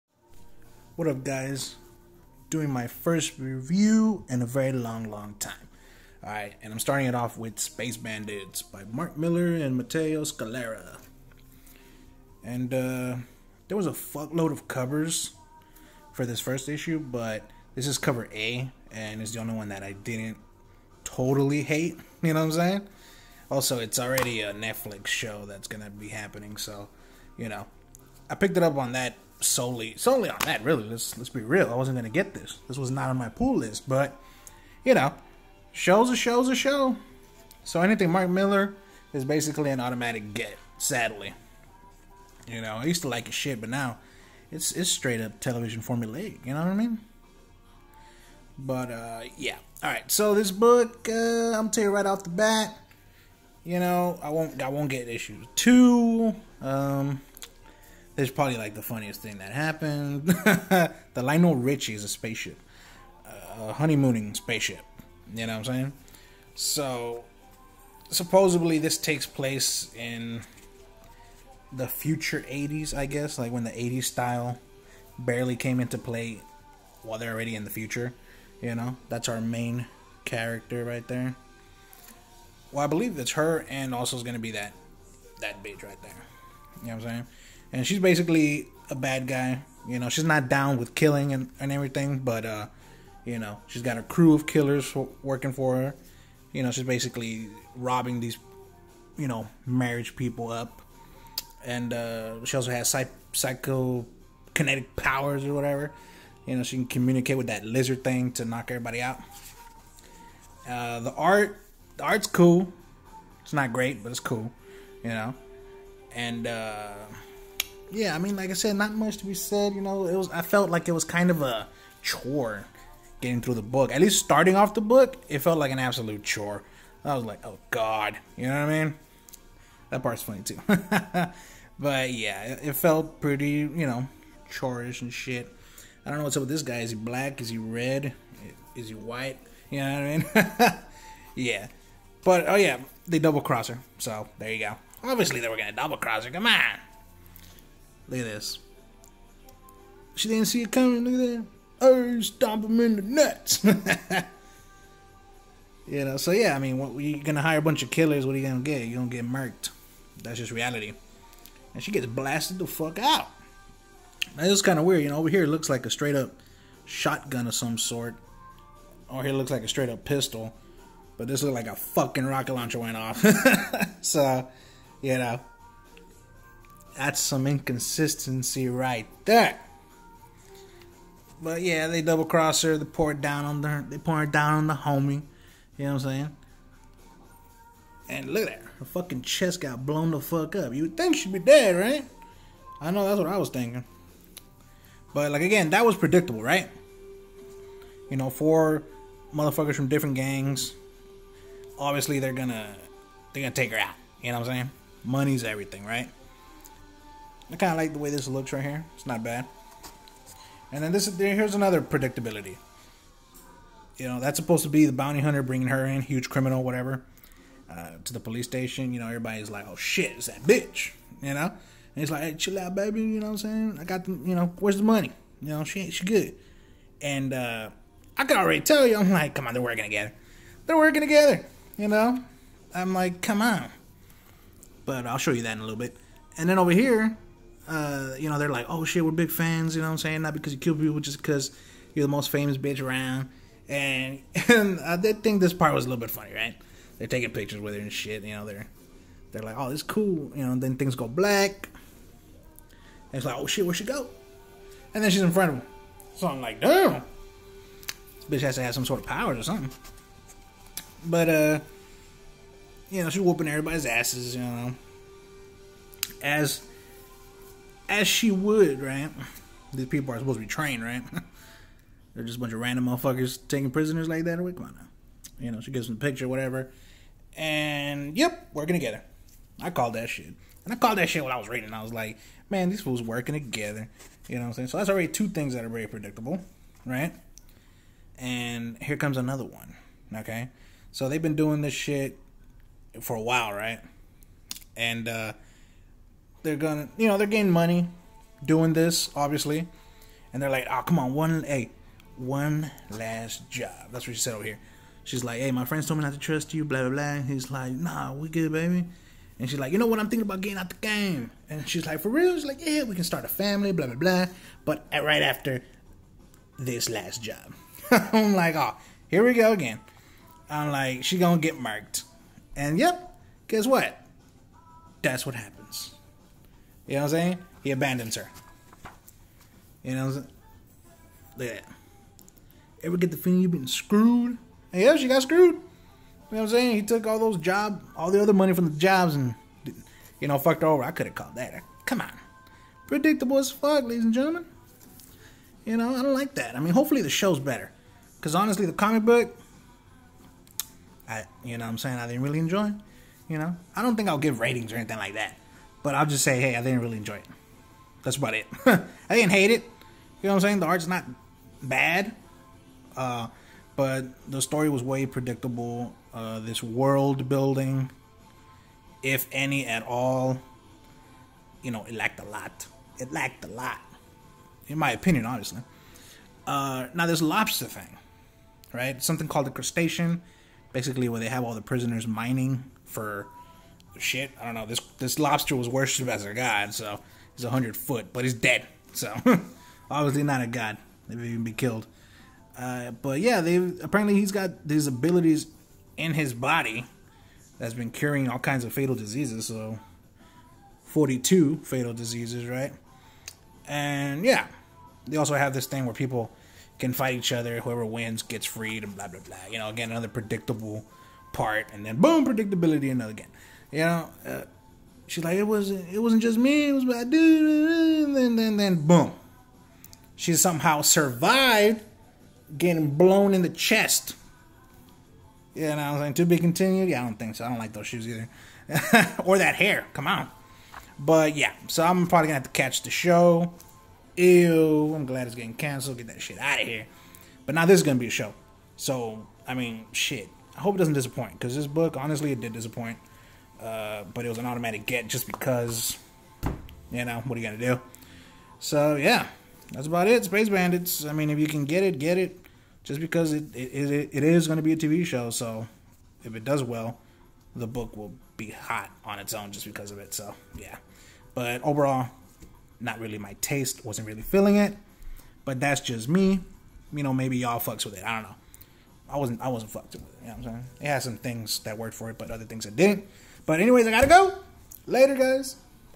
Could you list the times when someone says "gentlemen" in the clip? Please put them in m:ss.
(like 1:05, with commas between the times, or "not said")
5:44.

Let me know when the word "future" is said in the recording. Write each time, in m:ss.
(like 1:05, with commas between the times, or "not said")
1:11, 1:17.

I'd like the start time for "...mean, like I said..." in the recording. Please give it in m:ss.
1:58.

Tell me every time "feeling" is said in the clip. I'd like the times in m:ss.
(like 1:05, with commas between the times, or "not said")
5:33, 7:44.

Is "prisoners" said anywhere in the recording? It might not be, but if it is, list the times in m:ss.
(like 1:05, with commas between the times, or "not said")
4:33, 6:21.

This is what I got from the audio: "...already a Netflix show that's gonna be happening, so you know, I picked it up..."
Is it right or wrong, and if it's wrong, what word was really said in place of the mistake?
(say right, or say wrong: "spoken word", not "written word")
right.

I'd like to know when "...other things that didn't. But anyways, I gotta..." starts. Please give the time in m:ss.
7:52.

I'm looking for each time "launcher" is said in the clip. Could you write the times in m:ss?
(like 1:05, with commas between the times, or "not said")
2:52.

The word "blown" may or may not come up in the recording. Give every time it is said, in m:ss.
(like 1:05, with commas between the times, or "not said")
3:09, 7:02.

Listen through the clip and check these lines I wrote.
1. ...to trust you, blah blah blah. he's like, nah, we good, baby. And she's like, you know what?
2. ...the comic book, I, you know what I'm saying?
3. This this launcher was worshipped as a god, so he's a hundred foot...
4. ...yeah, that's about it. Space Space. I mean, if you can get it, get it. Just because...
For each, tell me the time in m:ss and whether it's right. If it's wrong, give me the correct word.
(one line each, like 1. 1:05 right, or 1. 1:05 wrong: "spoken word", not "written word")
1. 5:06 right
2. 5:48 right
3. 6:24 wrong: "lobster", not "launcher"
4. 7:28 wrong: "Bandits", not "Space".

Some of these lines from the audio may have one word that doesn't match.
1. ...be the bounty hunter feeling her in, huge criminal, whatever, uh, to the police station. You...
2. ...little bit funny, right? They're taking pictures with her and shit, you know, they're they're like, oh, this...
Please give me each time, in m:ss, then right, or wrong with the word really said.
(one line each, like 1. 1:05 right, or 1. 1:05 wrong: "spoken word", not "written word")
1. 3:34 wrong: "bringing", not "feeling"
2. 4:05 right.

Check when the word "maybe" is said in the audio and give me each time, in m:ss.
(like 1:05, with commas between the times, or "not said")
6:31, 7:47.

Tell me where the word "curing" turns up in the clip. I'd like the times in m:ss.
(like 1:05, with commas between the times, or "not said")
6:37.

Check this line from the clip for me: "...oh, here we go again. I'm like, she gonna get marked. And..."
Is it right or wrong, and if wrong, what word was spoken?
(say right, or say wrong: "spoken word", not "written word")
right.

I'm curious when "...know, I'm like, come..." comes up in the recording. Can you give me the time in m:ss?
3:51.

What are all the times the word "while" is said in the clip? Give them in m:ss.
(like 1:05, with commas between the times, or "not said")
1:17, 4:53.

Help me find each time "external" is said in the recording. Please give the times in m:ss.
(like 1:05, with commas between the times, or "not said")
not said.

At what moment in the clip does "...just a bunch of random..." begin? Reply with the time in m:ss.
4:32.